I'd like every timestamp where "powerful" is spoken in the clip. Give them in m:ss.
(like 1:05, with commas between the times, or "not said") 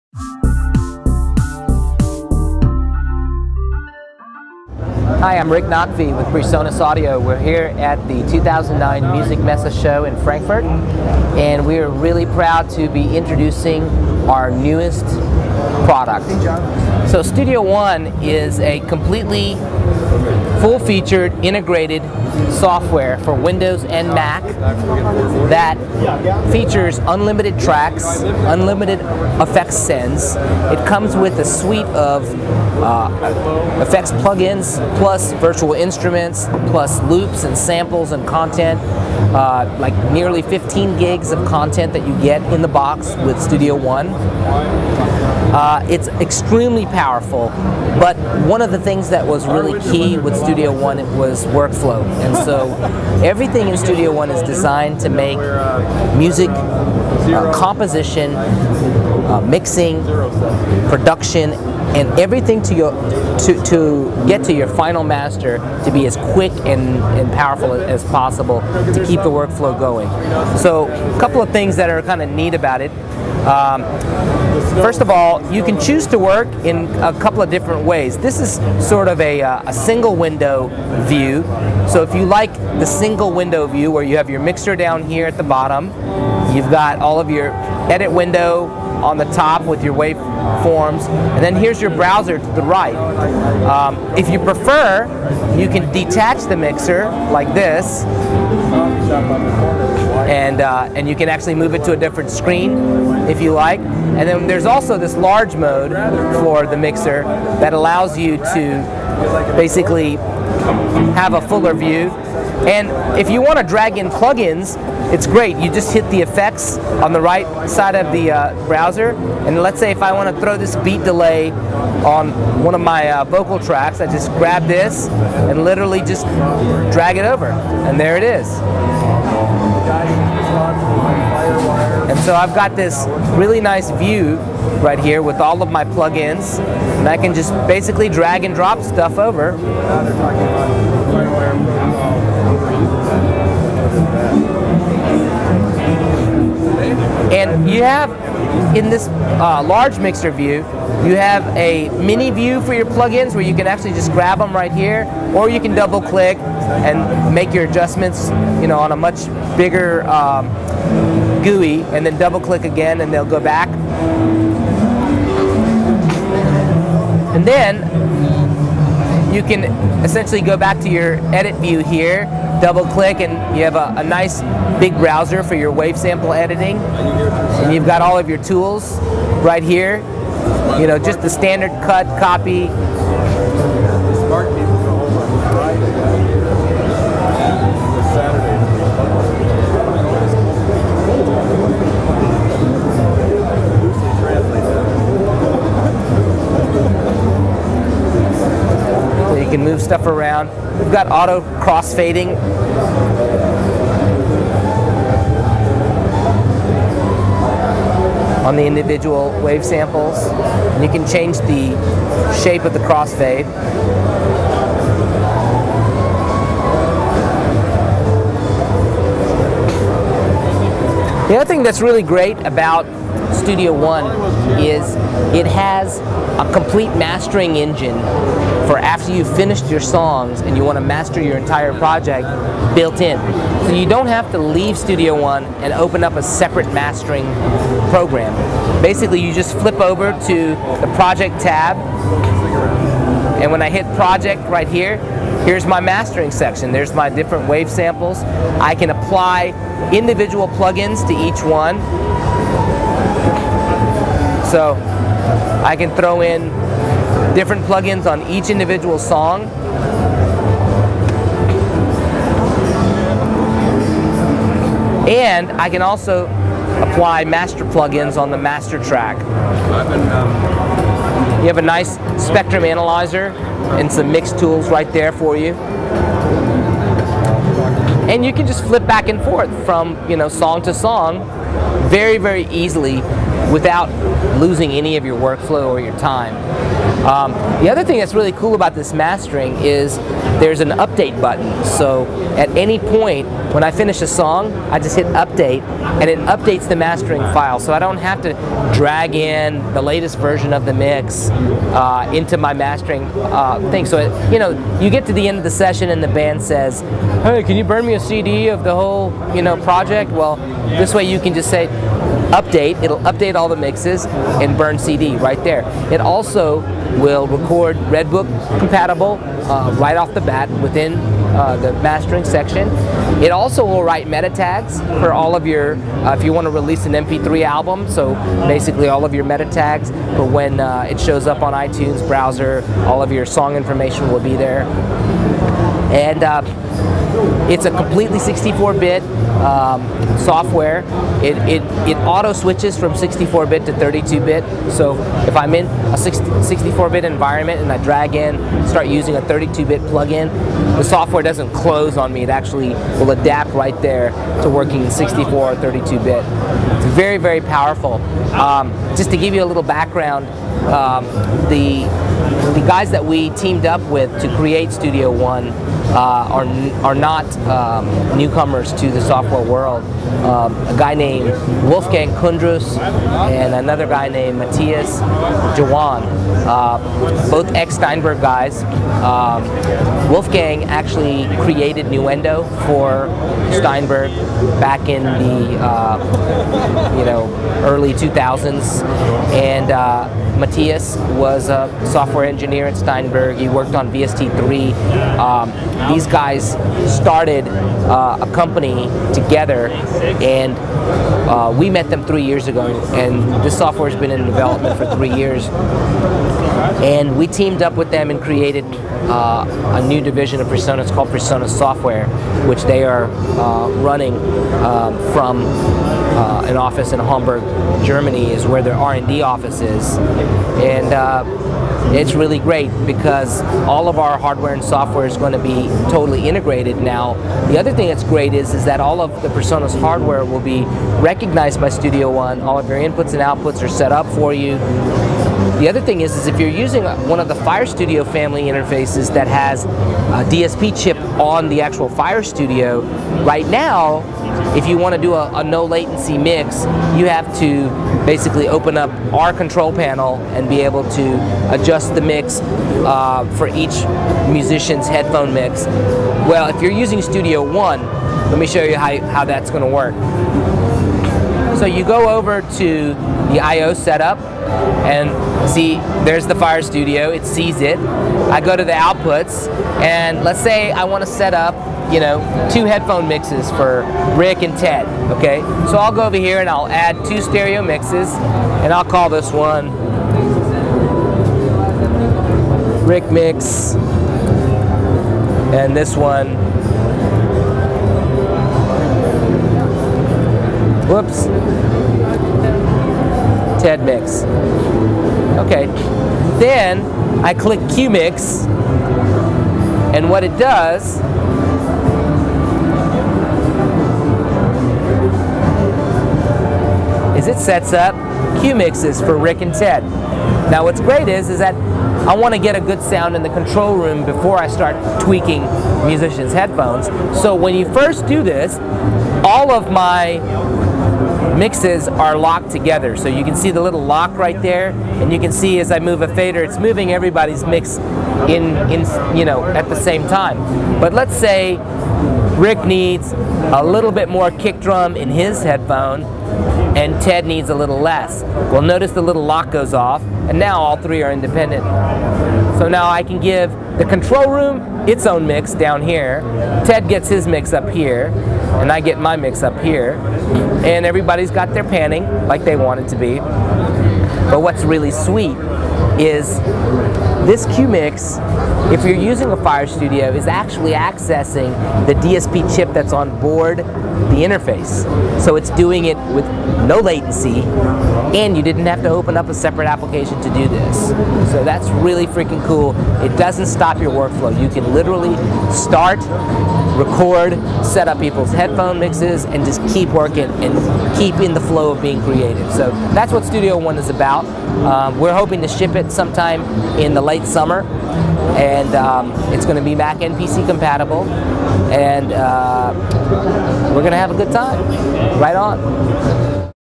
0:46, 1:07, 5:57.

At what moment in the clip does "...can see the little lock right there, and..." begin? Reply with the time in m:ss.
8:43.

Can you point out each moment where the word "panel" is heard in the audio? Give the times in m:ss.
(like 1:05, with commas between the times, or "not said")
7:29.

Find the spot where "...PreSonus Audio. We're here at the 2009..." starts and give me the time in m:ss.
0:06.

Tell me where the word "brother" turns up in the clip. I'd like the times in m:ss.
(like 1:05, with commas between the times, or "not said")
not said.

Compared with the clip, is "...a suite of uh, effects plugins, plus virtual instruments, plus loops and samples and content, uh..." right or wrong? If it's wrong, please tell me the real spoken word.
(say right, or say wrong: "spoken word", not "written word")
right.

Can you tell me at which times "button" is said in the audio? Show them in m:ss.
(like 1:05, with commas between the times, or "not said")
4:51.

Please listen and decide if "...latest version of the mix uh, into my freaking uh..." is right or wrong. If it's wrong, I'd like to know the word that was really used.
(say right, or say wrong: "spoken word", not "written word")
wrong: "mastering", not "freaking".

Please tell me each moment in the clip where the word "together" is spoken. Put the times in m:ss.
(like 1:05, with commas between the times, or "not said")
6:39, 8:42.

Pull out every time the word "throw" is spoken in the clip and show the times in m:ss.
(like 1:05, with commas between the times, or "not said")
2:00, 4:15.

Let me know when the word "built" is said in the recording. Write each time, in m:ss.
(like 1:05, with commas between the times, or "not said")
3:52.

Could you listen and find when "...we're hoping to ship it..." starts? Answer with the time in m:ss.
9:44.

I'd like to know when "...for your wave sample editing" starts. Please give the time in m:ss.
2:55.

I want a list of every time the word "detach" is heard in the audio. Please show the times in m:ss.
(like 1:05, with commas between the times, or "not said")
1:35.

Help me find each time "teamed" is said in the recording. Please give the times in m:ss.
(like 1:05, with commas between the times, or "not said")
6:03, 6:47.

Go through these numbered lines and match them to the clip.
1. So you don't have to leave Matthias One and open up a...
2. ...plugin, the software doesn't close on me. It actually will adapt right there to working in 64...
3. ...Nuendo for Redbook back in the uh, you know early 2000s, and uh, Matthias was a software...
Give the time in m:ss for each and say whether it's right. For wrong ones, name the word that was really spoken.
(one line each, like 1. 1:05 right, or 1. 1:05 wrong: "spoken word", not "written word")
1. 3:53 wrong: "Studio", not "Matthias"
2. 5:49 right
3. 6:21 wrong: "Steinberg", not "Redbook".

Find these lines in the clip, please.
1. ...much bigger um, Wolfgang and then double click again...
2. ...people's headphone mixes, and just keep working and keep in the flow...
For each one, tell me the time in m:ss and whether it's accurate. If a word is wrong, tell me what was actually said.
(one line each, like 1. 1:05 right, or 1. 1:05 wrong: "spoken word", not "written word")
1. 2:38 wrong: "GUI", not "Wolfgang"
2. 9:37 right.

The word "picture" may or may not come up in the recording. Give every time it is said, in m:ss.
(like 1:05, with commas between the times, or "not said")
not said.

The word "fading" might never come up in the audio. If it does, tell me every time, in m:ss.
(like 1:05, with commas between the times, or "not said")
3:21.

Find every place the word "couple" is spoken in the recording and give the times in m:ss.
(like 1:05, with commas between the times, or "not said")
1:11, 1:17.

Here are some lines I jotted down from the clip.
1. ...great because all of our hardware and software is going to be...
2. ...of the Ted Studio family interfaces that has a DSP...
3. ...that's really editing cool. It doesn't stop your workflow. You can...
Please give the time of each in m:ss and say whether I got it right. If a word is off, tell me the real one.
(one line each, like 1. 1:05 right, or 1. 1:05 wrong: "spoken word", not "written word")
1. 7:02 right
2. 7:17 wrong: "Fire", not "Ted"
3. 9:31 wrong: "freaking", not "editing".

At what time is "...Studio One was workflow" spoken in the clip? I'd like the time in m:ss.
0:50.